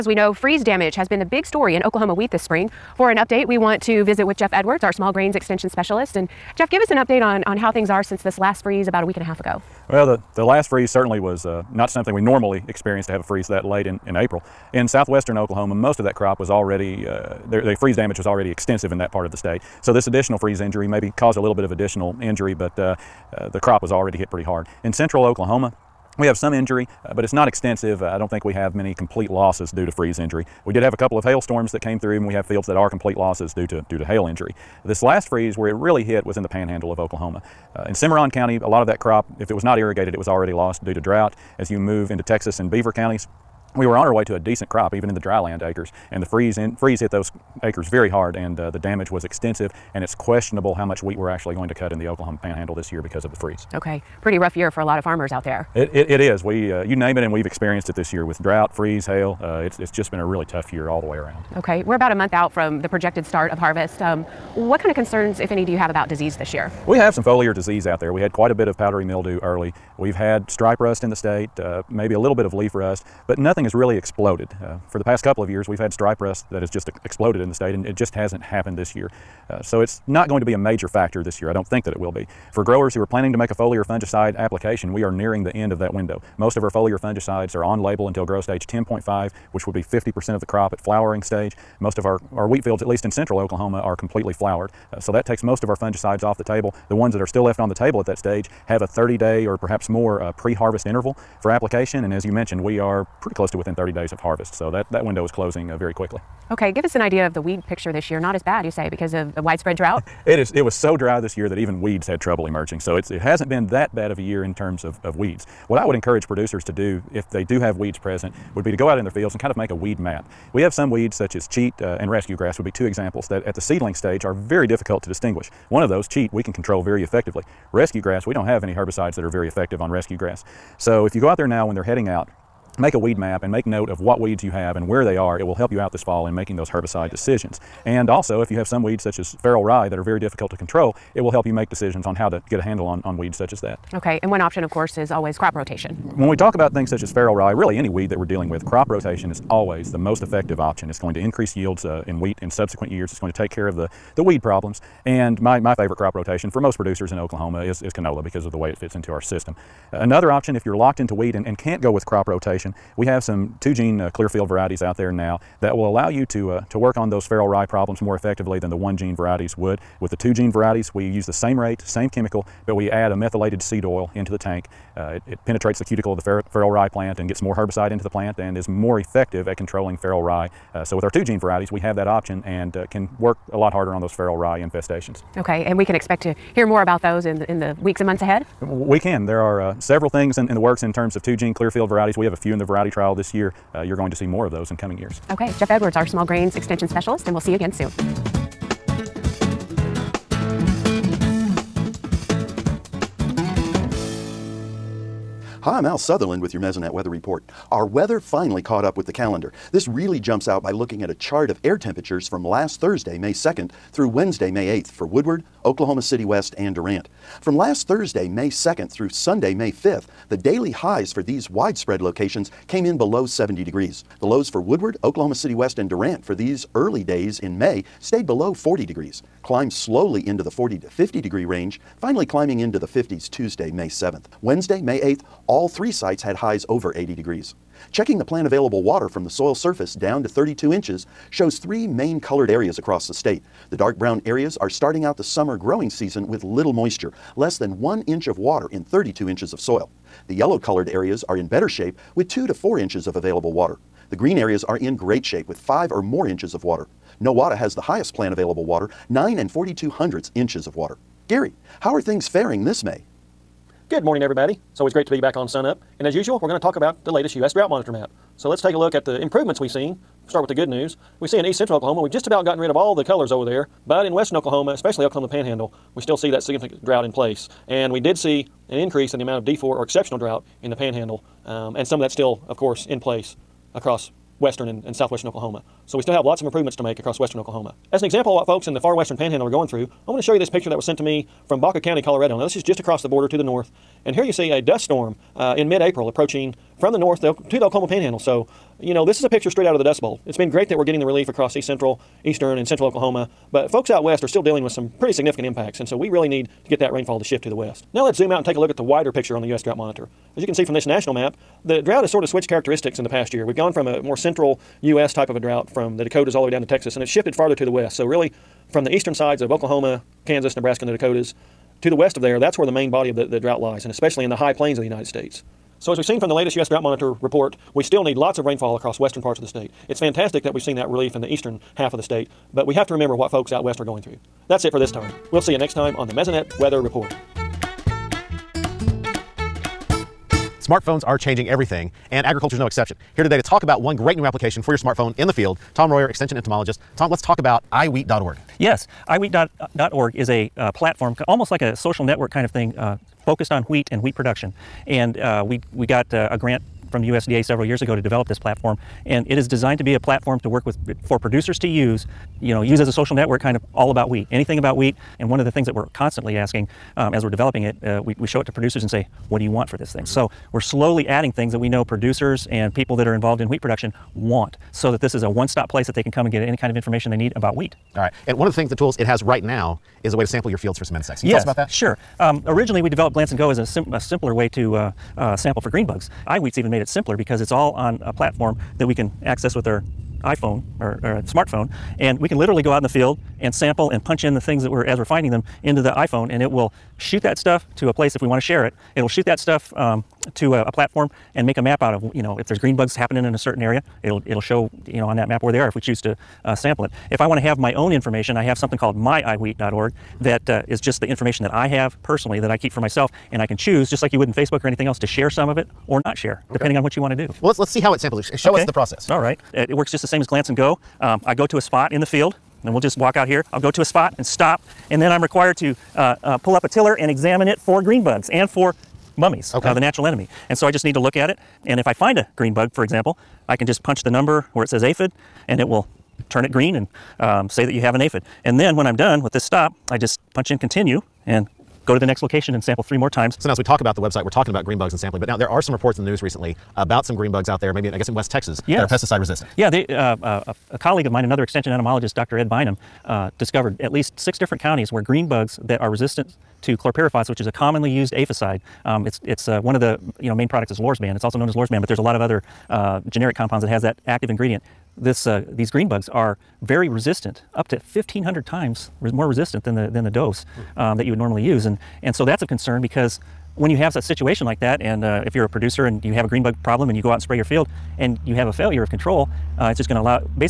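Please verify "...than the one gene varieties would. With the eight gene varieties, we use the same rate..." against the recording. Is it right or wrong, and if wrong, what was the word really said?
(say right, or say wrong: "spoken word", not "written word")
wrong: "two", not "eight".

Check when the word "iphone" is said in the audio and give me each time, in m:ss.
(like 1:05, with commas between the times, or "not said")
6:30, 6:35.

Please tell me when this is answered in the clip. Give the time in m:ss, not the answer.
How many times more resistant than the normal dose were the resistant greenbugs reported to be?
7:47.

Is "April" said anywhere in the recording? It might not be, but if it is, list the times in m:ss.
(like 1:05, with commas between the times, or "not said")
0:14, 4:55.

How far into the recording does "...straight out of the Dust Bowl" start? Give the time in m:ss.
4:59.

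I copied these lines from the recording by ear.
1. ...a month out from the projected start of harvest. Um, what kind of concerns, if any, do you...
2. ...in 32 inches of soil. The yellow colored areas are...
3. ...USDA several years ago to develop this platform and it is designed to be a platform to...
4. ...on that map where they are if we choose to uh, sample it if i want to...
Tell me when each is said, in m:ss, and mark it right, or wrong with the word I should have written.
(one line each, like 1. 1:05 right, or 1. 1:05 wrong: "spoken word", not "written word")
1. 1:02 right
2. 4:08 right
3. 5:57 right
4. 6:45 right.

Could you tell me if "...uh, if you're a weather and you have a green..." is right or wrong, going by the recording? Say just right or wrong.
wrong.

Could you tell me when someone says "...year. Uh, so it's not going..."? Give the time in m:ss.
1:18.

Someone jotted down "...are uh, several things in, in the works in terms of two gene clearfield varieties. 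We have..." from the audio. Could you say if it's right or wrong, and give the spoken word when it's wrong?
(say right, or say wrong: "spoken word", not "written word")
right.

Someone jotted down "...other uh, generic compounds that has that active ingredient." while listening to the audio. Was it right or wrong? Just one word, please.
right.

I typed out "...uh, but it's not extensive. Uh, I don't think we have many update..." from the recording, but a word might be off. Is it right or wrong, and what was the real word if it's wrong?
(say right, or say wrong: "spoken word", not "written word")
wrong: "complete", not "update".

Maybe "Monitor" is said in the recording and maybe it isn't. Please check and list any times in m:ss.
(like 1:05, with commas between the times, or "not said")
4:27, 5:09, 5:26.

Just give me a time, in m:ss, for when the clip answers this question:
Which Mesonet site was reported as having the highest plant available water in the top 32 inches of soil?
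4:17.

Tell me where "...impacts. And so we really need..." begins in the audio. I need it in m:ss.
5:05.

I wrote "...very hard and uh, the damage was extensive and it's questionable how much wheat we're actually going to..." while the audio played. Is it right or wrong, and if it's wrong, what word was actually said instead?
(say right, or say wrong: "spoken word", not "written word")
right.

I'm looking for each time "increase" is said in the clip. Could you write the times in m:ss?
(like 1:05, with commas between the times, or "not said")
2:31, 4:38.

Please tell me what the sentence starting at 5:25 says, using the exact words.
So as we've seen from the latest U.S.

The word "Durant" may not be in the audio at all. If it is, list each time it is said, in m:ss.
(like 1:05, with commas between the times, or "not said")
3:36, 3:45.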